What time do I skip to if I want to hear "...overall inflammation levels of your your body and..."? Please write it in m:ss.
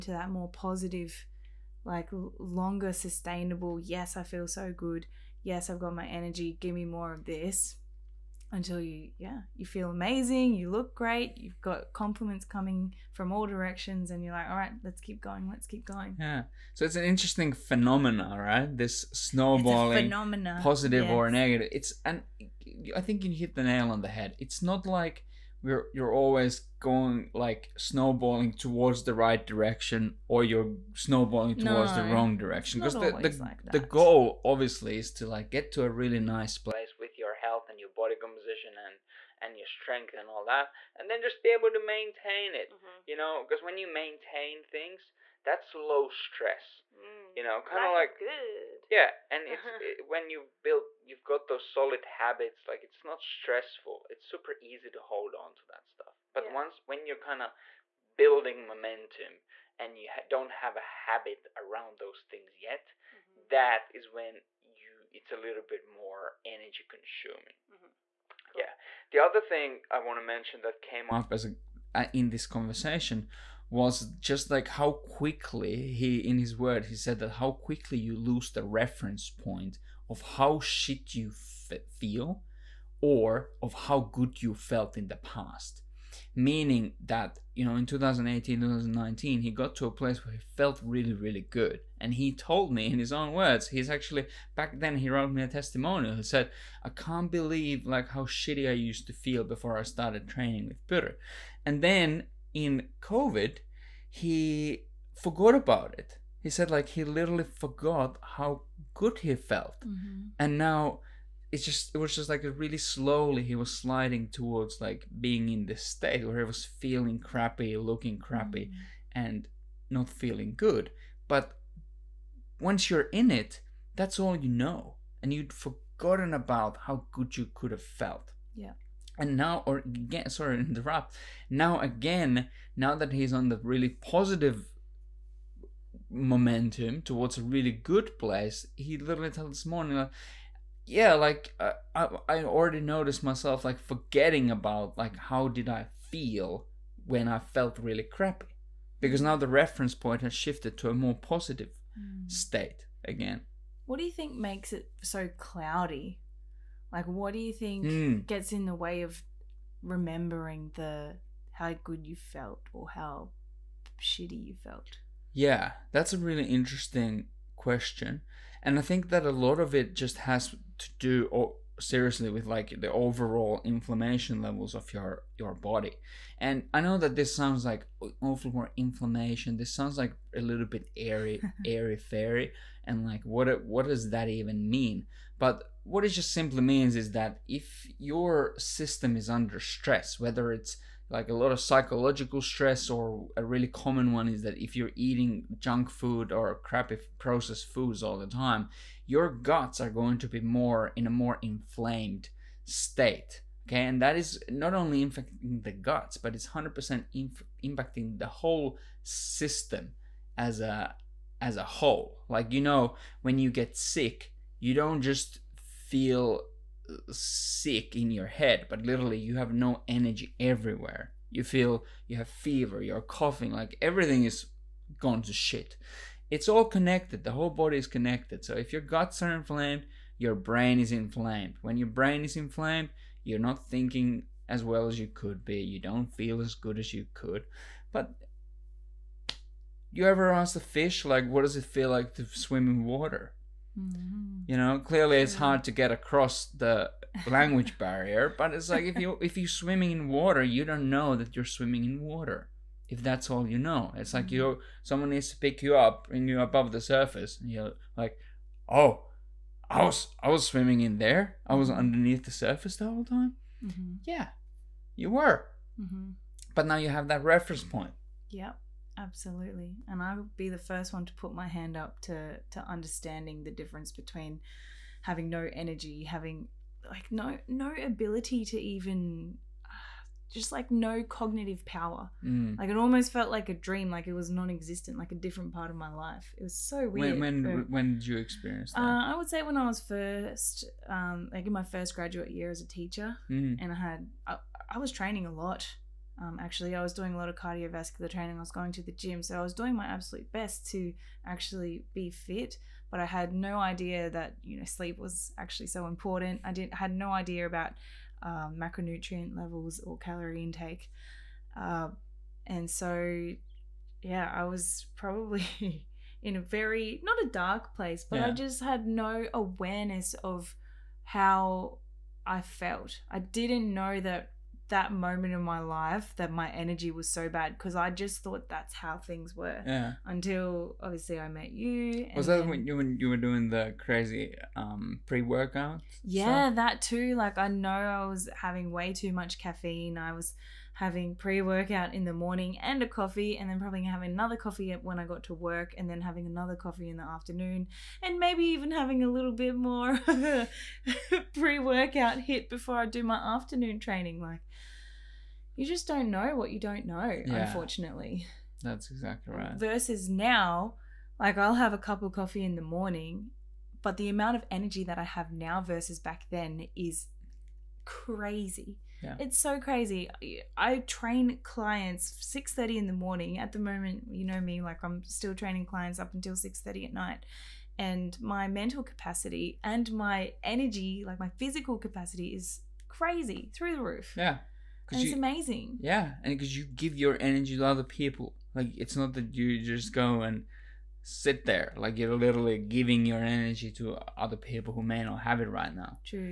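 2:52.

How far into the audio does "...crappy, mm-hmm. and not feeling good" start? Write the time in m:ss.
1:58.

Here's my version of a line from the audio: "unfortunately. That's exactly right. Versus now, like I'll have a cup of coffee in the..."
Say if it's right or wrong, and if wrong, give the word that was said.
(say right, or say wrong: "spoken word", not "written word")
right.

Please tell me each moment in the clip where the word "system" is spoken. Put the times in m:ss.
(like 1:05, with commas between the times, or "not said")
3:08, 3:29.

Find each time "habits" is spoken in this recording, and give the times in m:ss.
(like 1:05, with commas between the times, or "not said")
0:52, 1:00.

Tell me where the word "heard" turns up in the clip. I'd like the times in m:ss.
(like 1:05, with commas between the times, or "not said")
not said.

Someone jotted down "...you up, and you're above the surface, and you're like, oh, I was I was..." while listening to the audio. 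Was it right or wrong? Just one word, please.
right.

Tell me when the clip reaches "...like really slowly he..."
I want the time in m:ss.
1:52.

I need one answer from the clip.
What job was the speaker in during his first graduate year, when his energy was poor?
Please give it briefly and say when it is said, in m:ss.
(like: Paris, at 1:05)
teacher, at 4:52.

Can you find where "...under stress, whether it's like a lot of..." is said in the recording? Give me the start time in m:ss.
3:09.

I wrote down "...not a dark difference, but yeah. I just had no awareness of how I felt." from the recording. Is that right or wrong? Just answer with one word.
wrong.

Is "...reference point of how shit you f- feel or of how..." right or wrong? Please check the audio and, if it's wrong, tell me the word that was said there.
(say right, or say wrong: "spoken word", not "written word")
right.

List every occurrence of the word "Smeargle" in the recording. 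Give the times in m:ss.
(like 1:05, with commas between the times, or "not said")
not said.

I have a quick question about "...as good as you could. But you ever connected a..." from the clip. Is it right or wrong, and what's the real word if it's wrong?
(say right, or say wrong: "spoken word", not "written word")
wrong: "asked", not "connected".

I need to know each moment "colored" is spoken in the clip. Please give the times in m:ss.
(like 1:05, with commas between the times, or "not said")
not said.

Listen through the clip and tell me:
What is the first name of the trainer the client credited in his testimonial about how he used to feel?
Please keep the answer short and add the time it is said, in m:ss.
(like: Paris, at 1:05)
Peter, at 1:40.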